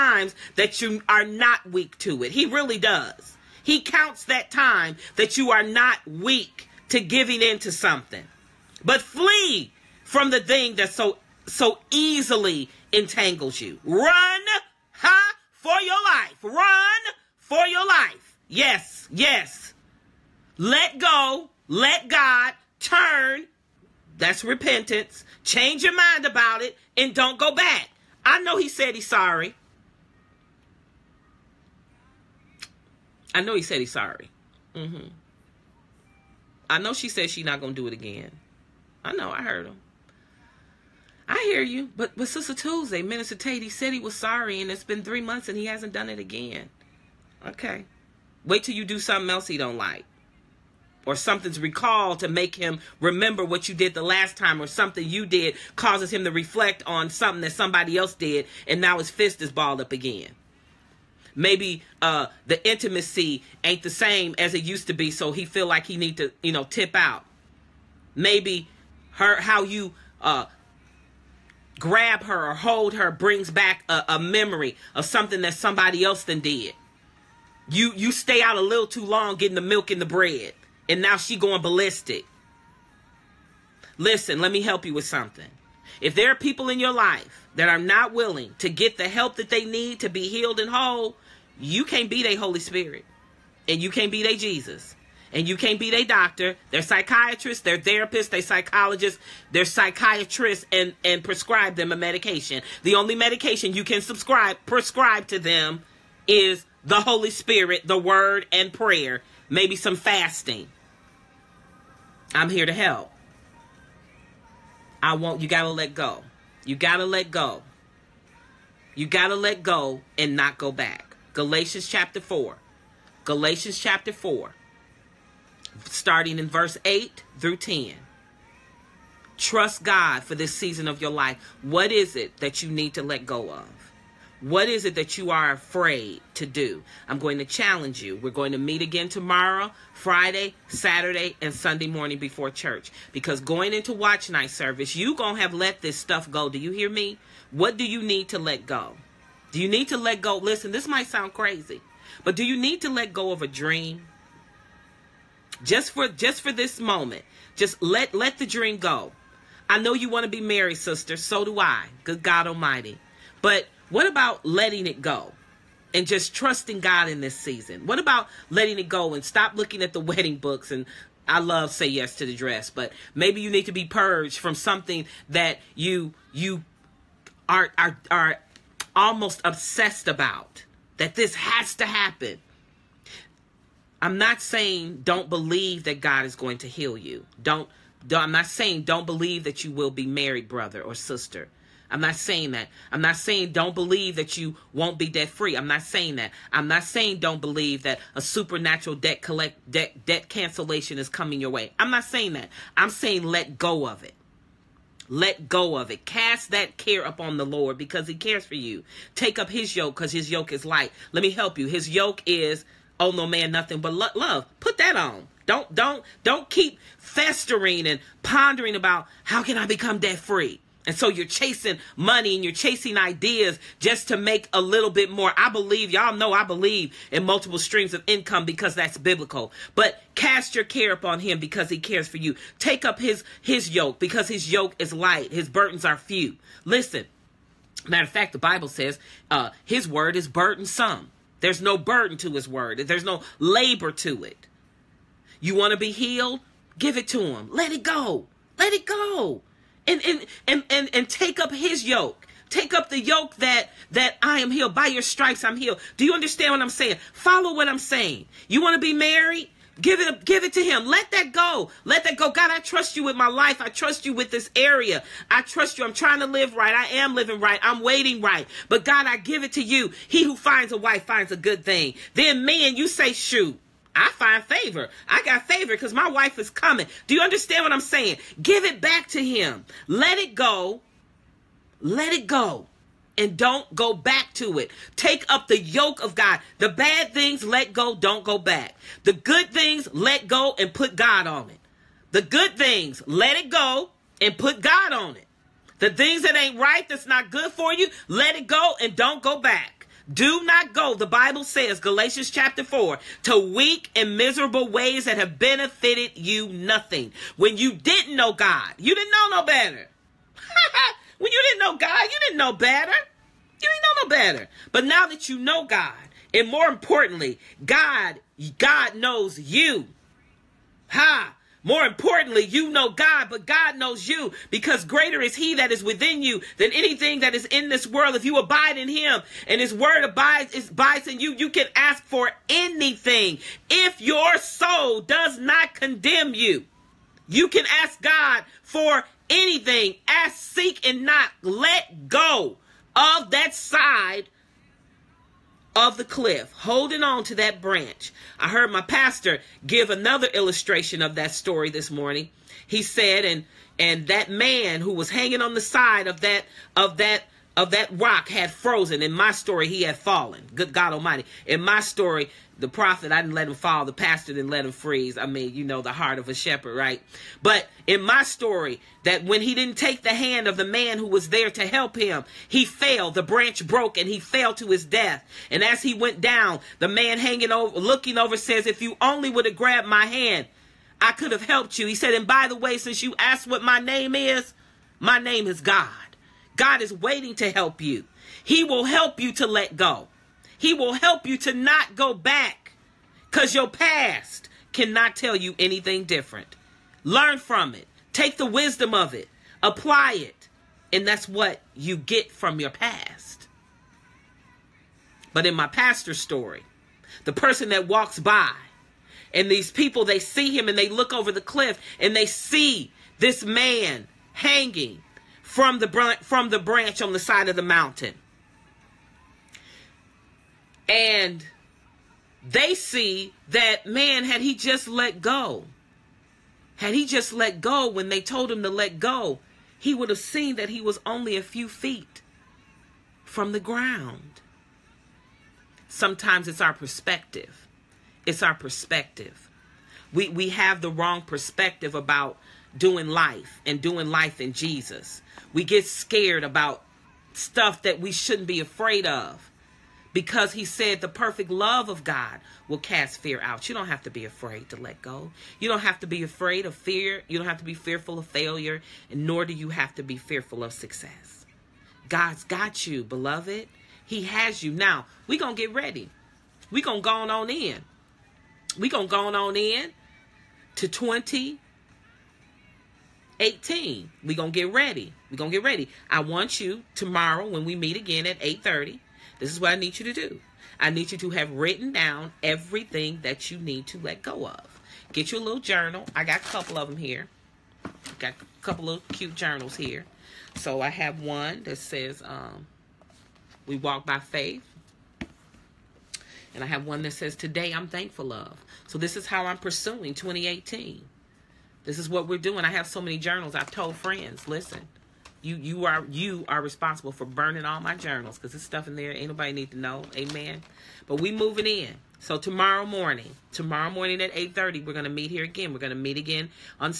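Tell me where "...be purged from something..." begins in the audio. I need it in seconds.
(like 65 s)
173 s.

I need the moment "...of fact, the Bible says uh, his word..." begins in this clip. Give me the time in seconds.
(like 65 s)
238 s.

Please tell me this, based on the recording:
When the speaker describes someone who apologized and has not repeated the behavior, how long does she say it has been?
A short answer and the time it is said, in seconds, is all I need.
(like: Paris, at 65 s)
3 months, at 45 s.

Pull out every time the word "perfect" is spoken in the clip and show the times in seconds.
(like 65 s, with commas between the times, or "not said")
451 s.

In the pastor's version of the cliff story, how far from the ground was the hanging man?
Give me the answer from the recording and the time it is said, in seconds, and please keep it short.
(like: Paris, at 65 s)
a few feet, at 431 s.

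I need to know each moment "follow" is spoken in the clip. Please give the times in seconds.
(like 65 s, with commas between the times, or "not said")
257 s.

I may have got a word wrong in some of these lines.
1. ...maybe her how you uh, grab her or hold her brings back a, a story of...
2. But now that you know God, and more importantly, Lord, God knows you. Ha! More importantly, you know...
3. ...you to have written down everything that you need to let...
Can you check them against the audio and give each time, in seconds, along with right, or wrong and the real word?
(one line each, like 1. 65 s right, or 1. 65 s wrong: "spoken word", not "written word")
1. 68 s wrong: "memory", not "story"
2. 314 s wrong: "God", not "Lord"
3. 481 s right.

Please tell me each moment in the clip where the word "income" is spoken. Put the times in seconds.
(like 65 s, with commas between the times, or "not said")
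228 s.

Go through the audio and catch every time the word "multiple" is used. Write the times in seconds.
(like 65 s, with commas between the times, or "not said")
227 s.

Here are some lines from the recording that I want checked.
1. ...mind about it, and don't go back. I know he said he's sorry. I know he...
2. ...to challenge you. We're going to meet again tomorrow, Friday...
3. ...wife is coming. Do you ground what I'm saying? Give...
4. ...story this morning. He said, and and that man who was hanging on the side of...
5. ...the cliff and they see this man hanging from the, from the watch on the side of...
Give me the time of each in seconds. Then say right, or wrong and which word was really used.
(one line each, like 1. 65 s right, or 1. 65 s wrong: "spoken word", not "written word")
1. 25 s right
2. 137 s right
3. 276 s wrong: "understand", not "ground"
4. 351 s right
5. 411 s wrong: "branch", not "watch".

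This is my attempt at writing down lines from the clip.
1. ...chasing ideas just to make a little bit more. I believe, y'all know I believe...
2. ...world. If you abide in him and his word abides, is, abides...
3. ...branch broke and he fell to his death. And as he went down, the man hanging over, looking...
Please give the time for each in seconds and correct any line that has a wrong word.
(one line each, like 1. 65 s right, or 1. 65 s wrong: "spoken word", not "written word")
1. 222 s right
2. 327 s right
3. 373 s right.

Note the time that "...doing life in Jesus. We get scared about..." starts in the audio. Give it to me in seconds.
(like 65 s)
443 s.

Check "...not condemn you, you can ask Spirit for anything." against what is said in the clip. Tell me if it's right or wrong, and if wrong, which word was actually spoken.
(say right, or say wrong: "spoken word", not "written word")
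wrong: "God", not "Spirit".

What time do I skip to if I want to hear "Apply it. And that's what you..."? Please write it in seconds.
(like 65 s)
399 s.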